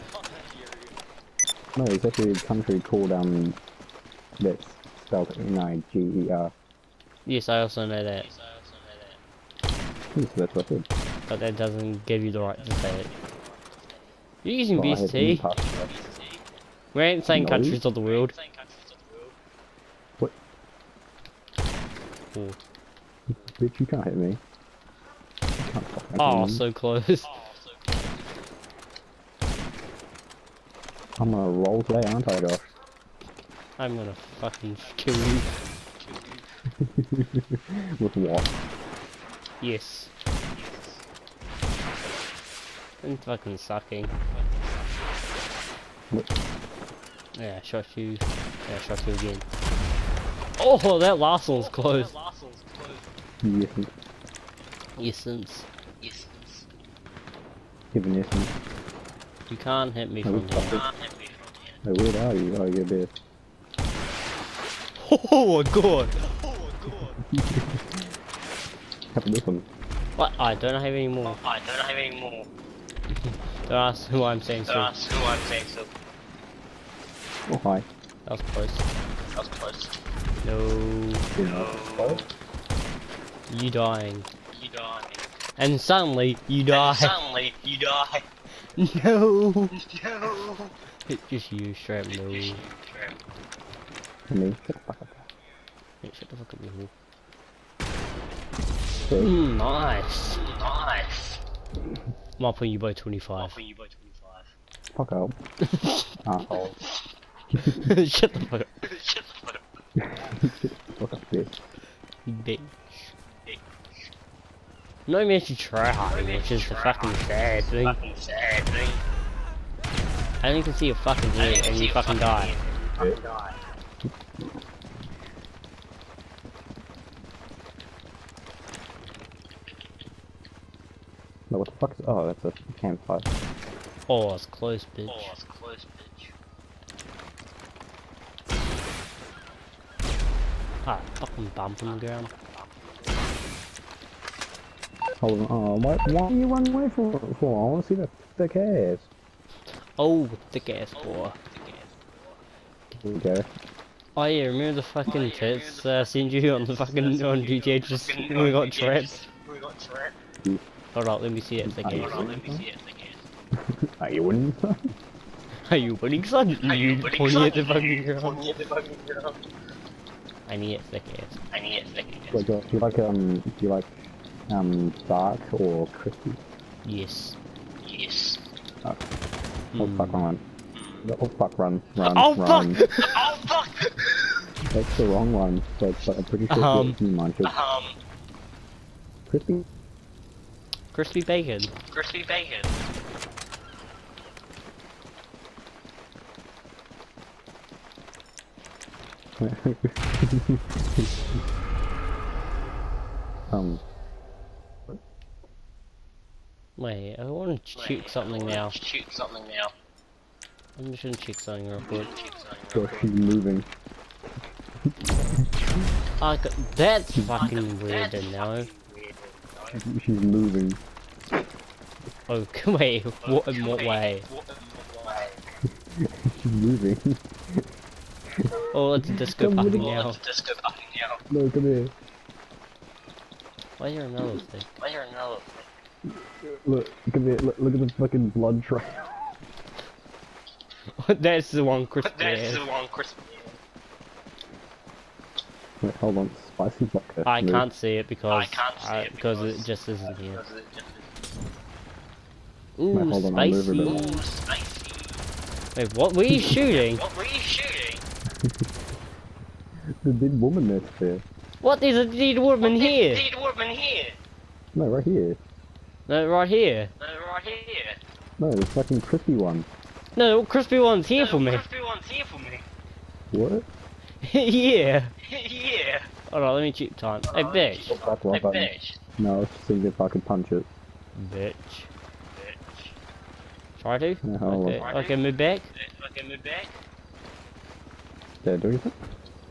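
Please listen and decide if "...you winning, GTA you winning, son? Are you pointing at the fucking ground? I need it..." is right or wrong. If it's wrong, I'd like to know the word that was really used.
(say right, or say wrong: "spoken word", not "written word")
wrong: "Are", not "GTA".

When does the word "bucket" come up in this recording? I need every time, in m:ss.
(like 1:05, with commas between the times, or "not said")
4:06.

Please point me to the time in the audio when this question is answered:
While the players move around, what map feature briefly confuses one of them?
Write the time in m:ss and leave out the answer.
2:12.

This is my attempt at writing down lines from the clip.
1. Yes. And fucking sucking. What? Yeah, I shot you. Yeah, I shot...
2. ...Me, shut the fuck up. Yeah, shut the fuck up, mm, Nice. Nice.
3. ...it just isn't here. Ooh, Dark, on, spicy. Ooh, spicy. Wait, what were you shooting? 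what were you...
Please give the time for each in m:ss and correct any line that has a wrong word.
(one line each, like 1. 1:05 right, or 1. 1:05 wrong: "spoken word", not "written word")
1. 0:39 right
2. 1:34 right
3. 4:09 wrong: "Wait", not "Dark".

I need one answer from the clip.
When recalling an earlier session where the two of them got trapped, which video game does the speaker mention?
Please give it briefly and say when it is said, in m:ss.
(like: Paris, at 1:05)
GTA, at 2:37.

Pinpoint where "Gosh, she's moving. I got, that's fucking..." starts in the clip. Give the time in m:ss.
3:32.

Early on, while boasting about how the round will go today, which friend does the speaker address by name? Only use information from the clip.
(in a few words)
Josh.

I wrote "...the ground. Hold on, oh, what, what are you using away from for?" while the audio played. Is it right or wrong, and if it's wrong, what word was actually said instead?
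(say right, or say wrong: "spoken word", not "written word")
wrong: "running", not "using".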